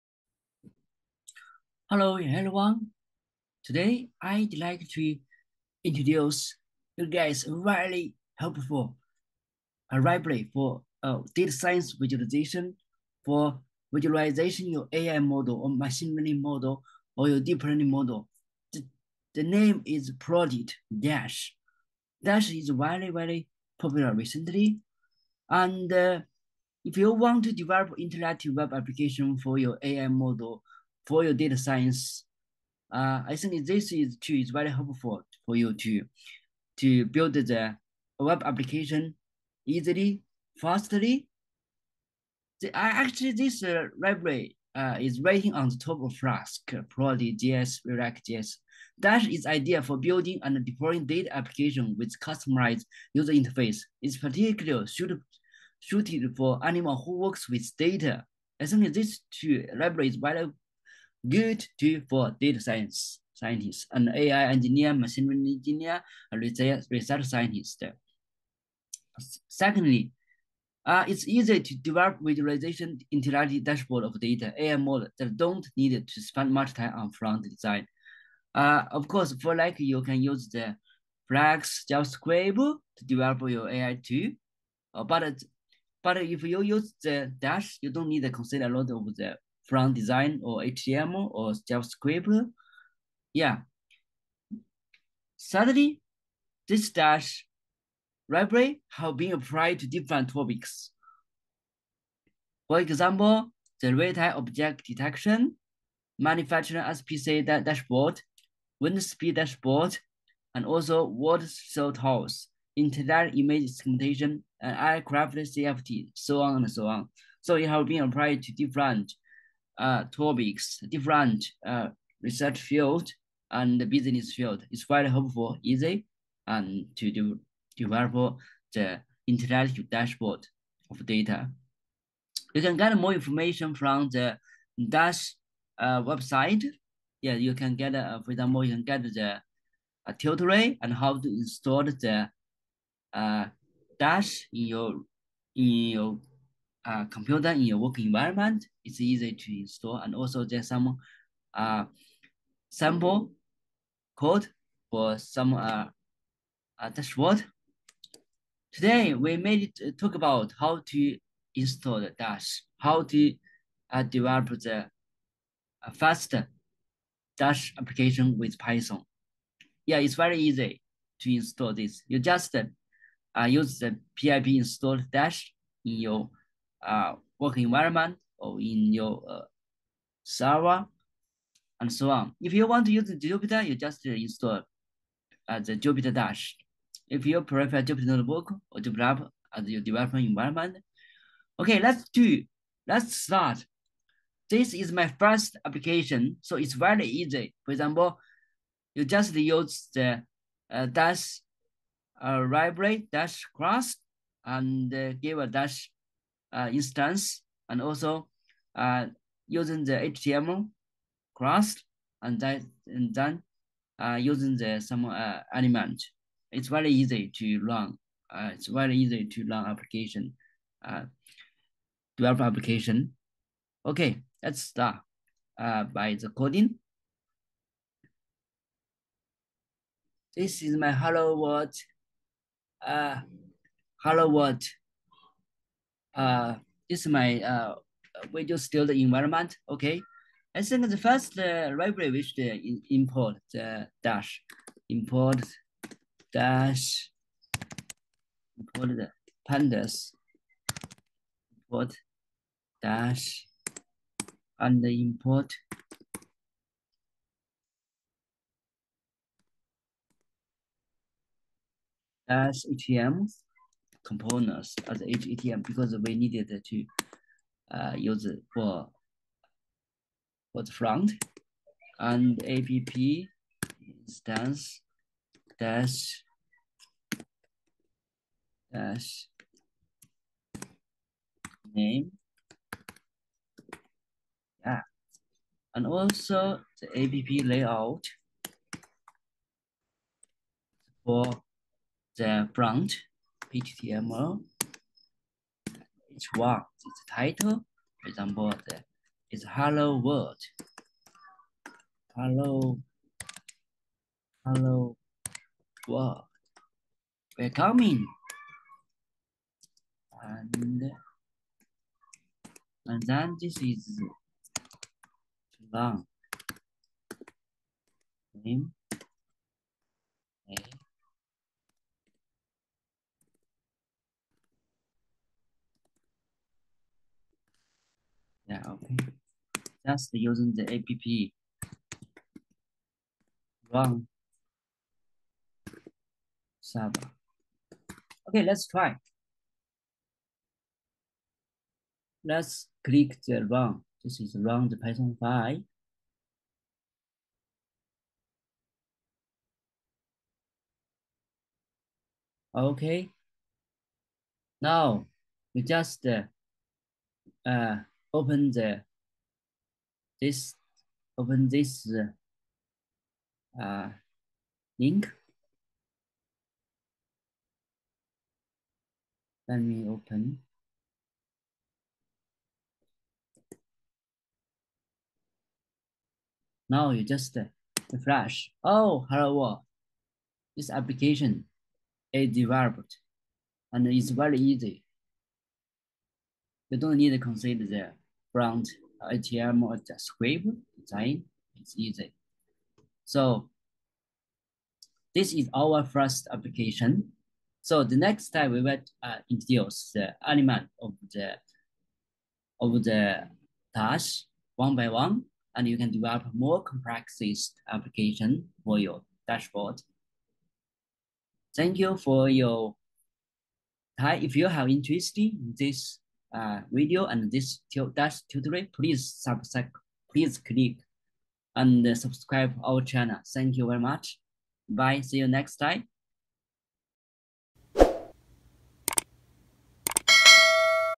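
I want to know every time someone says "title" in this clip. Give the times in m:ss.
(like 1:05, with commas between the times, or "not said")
4:57.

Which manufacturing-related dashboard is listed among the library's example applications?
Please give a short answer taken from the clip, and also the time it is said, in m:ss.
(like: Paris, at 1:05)
manufacturing SPC dashboard, at 1:46.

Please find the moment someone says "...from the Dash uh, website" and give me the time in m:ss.
2:13.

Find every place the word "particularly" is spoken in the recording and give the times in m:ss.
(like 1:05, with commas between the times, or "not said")
0:54.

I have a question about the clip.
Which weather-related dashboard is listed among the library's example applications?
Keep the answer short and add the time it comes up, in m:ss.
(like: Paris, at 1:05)
wind speed dashboard, at 1:48.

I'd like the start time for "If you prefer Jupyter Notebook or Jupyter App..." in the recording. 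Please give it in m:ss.
3:07.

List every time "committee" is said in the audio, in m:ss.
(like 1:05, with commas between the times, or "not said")
not said.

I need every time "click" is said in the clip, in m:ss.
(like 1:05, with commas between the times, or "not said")
5:42, 7:00.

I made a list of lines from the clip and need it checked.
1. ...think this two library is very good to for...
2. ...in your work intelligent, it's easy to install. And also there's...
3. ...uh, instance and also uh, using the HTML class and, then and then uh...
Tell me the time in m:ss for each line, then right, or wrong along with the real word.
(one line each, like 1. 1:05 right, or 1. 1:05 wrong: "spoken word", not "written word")
1. 0:58 right
2. 2:27 wrong: "environment", not "intelligent"
3. 3:26 right.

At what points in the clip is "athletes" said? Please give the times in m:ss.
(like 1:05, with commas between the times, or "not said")
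not said.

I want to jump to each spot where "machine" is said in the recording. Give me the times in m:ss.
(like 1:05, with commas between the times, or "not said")
0:15, 1:04.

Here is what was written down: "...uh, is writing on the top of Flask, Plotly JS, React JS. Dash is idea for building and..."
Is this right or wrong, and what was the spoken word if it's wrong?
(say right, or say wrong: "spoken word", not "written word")
right.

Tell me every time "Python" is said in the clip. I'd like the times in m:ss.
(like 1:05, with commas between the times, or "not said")
2:48, 5:44.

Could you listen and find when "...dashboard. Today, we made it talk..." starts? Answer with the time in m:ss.
2:36.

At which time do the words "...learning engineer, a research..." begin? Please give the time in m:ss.
1:05.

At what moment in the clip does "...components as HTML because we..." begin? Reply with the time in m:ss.
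4:24.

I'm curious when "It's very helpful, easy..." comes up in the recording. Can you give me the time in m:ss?
2:04.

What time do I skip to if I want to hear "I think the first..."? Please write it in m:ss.
4:00.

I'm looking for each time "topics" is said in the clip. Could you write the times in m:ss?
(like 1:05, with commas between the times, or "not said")
1:40, 2:00.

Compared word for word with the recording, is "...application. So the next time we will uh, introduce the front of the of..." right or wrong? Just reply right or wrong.
wrong.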